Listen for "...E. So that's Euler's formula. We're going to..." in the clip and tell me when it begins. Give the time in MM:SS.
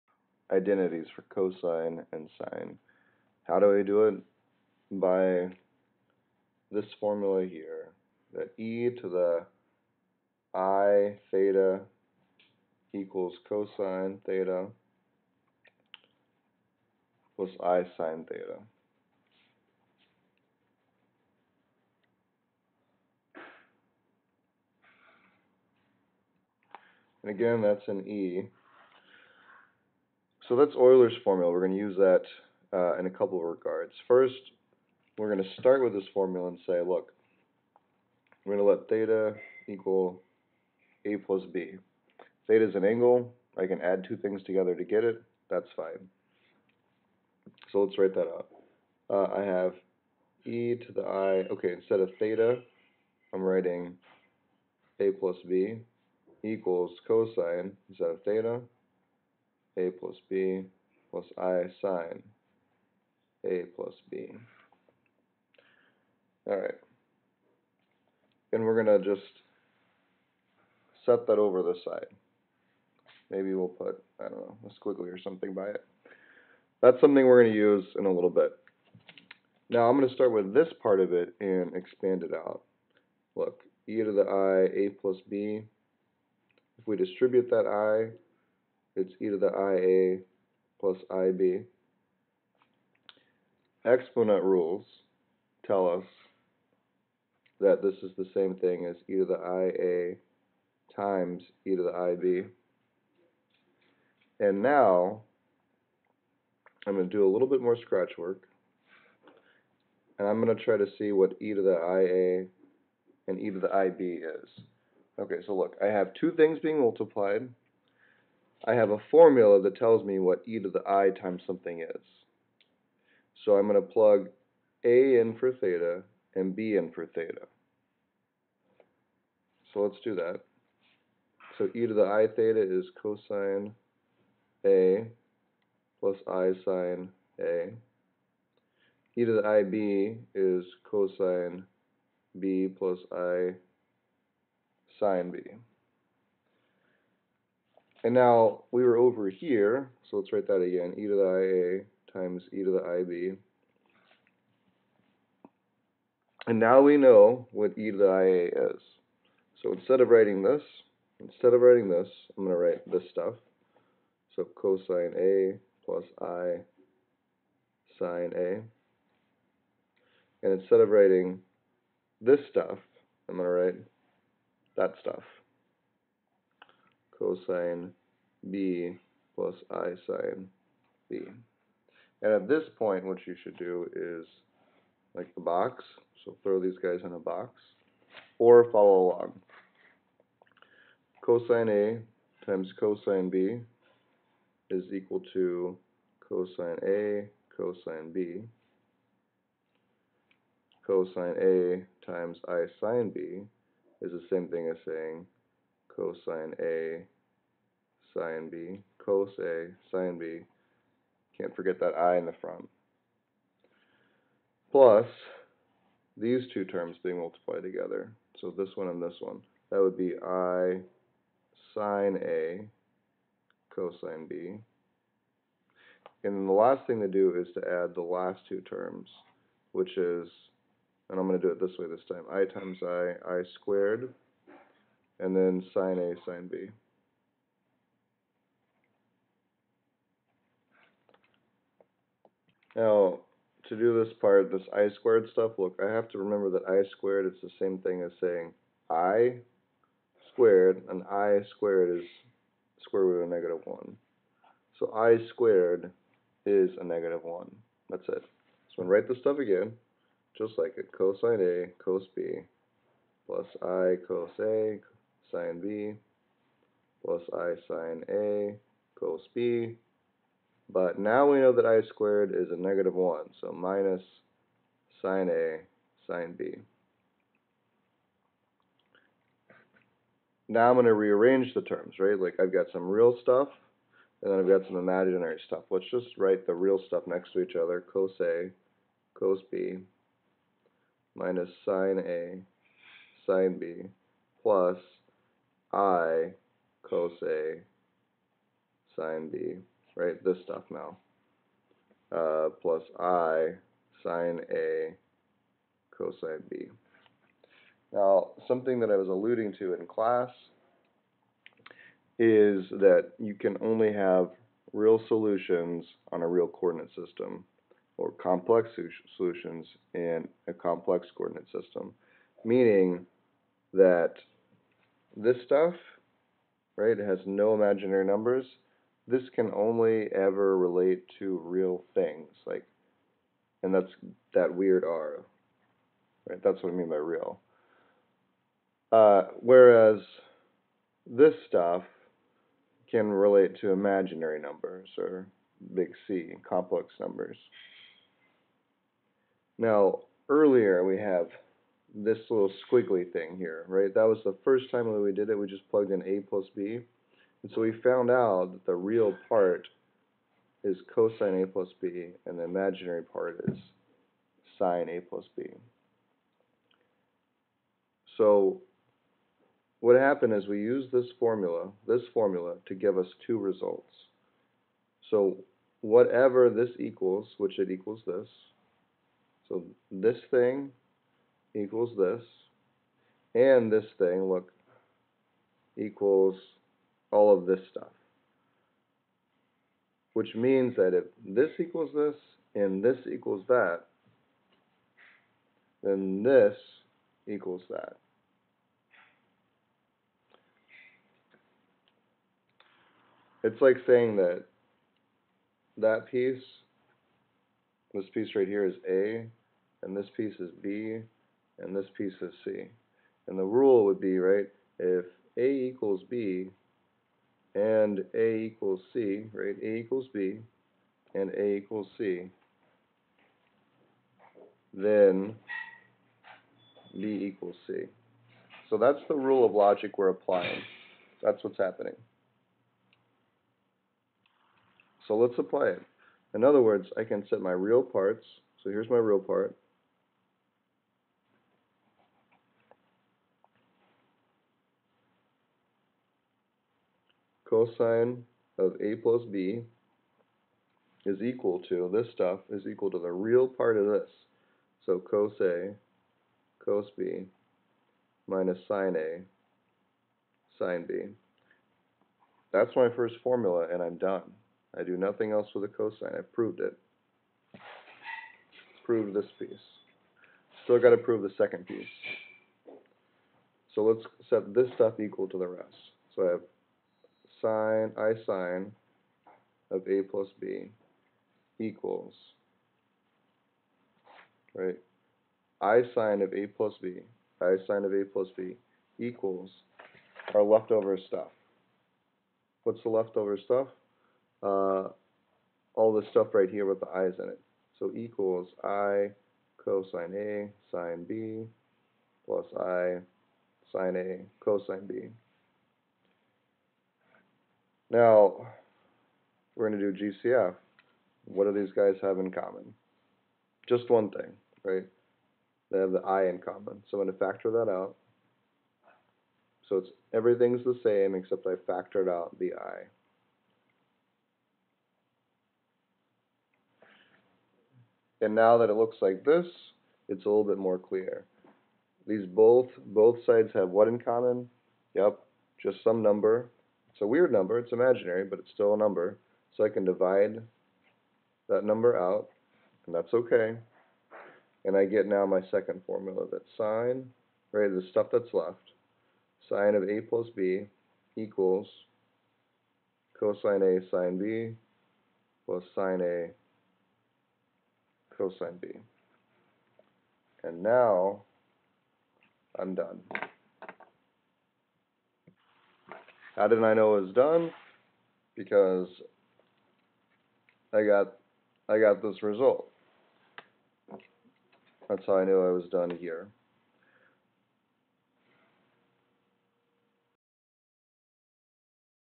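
00:28.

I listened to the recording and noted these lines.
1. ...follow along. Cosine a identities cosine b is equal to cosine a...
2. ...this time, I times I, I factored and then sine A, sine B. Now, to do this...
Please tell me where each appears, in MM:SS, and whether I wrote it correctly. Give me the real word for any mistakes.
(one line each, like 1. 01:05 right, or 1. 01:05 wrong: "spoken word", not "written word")
1. 03:08 wrong: "times", not "identities"
2. 03:51 wrong: "squared", not "factored".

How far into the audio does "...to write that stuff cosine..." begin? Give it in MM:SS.
02:53.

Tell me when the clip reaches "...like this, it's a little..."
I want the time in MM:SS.
08:49.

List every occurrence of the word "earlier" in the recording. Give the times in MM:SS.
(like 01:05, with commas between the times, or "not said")
05:50.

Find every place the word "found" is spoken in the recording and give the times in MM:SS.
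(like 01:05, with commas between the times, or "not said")
05:57.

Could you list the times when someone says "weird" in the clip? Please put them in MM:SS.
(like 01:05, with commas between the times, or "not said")
05:34, 08:57.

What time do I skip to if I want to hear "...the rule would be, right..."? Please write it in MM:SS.
06:53.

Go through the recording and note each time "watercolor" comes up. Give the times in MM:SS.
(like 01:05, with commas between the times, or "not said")
not said.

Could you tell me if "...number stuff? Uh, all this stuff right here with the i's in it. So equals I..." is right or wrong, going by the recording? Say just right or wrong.
wrong.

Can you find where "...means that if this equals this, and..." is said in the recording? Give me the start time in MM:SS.
06:30.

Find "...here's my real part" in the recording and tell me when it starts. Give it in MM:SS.
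07:18.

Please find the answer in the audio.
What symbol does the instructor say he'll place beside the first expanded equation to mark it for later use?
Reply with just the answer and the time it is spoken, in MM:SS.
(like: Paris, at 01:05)
A squiggly, at 01:14.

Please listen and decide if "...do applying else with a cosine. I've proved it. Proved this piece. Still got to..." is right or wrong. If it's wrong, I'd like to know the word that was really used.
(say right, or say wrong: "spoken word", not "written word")
wrong: "nothing", not "applying".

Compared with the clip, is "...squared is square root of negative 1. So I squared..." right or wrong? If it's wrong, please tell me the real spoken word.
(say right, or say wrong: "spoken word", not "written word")
right.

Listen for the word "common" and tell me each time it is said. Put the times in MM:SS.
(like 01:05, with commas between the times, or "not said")
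08:32, 08:36, 08:53.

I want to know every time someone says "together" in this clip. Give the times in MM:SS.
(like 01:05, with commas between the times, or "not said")
00:44, 03:37.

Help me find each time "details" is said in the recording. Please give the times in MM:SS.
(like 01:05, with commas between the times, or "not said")
not said.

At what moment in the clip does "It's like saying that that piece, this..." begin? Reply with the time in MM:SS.
06:43.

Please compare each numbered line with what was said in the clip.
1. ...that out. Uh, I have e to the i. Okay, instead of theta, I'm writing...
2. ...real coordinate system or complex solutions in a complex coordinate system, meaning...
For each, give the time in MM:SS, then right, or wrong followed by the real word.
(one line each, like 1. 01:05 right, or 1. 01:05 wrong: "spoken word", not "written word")
1. 00:48 right
2. 05:16 right.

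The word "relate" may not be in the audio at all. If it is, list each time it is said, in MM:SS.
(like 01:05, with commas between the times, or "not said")
05:30, 05:43.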